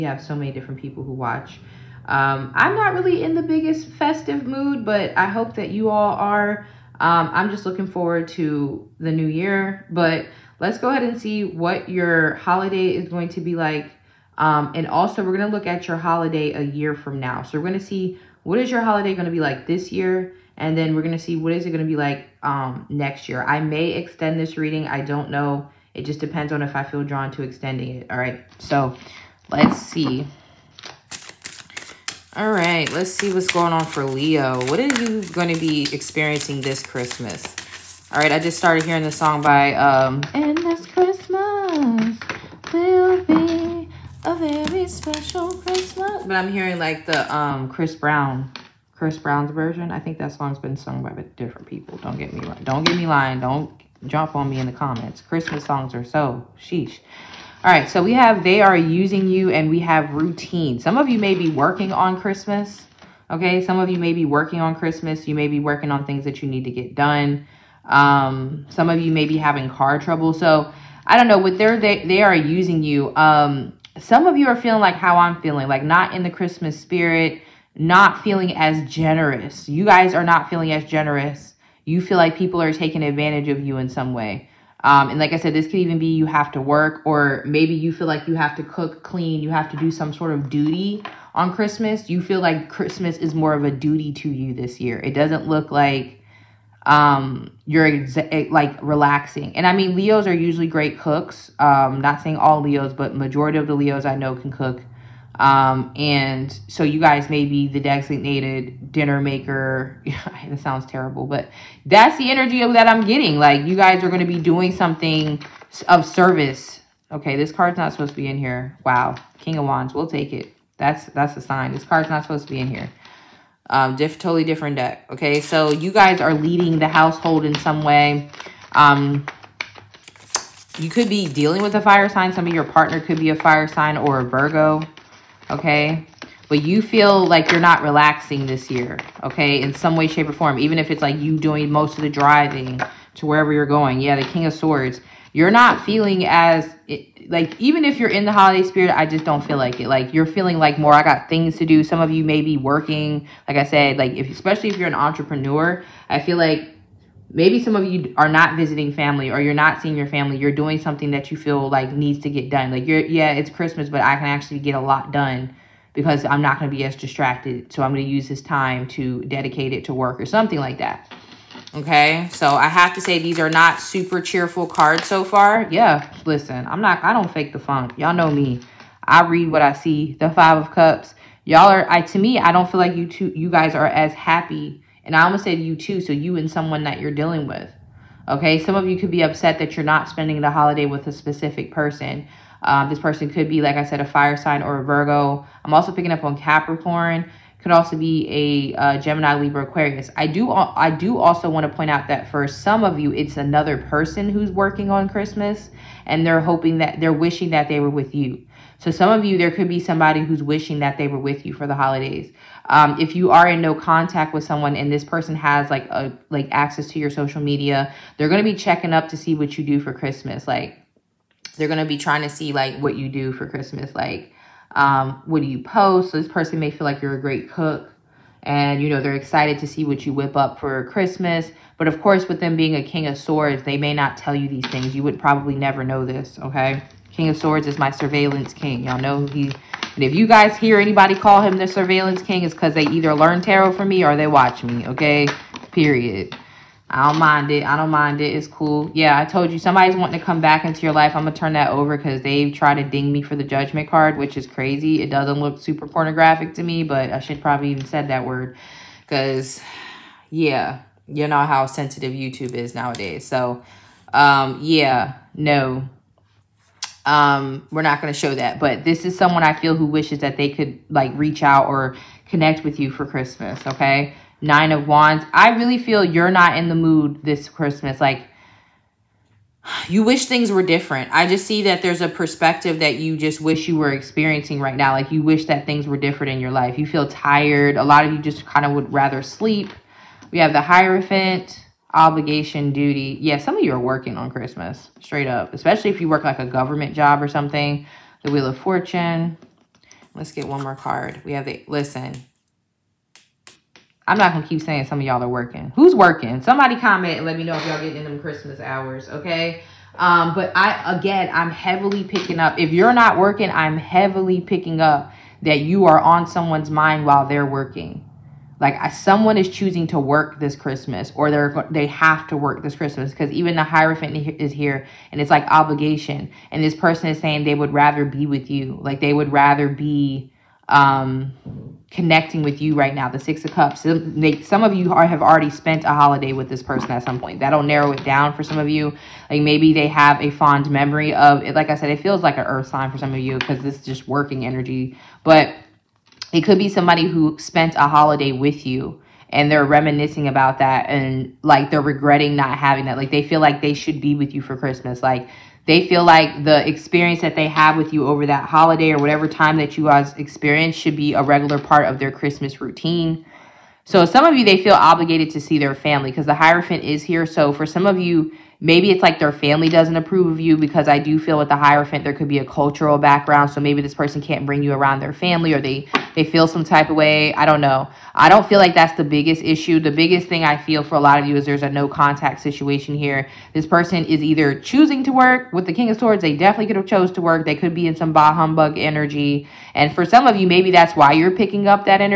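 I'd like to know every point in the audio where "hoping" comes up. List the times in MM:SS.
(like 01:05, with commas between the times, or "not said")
03:26.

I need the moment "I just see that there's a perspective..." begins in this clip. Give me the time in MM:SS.
04:41.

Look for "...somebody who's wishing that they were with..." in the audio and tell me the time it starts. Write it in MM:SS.
03:29.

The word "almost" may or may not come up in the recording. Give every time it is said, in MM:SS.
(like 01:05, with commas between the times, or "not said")
03:05.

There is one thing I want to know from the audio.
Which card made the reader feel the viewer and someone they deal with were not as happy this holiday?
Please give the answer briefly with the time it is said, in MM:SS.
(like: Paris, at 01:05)
Five of Cups, at 03:00.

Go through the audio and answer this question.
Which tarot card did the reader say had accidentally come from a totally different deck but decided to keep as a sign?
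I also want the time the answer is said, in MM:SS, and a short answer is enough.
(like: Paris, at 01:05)
King of Wands, at 01:59.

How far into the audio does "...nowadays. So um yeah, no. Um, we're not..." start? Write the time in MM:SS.
04:22.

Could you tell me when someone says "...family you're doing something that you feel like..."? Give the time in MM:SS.
02:40.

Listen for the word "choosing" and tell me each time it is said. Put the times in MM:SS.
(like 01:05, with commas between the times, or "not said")
05:19, 06:24.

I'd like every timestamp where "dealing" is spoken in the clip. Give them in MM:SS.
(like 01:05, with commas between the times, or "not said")
02:11, 03:07.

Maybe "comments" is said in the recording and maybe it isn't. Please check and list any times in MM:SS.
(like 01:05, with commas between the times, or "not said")
00:54, 05:06.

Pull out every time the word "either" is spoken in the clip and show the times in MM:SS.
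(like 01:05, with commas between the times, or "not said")
04:02, 06:24.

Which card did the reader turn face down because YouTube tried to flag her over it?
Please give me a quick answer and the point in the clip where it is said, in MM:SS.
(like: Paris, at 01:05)
Judgment, at 04:13.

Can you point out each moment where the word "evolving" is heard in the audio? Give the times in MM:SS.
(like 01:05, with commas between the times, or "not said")
not said.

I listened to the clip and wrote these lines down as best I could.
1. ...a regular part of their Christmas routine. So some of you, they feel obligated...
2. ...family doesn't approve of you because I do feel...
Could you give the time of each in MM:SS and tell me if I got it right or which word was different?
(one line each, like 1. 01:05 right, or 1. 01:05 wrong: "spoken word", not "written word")
1. 06:01 right
2. 06:09 right.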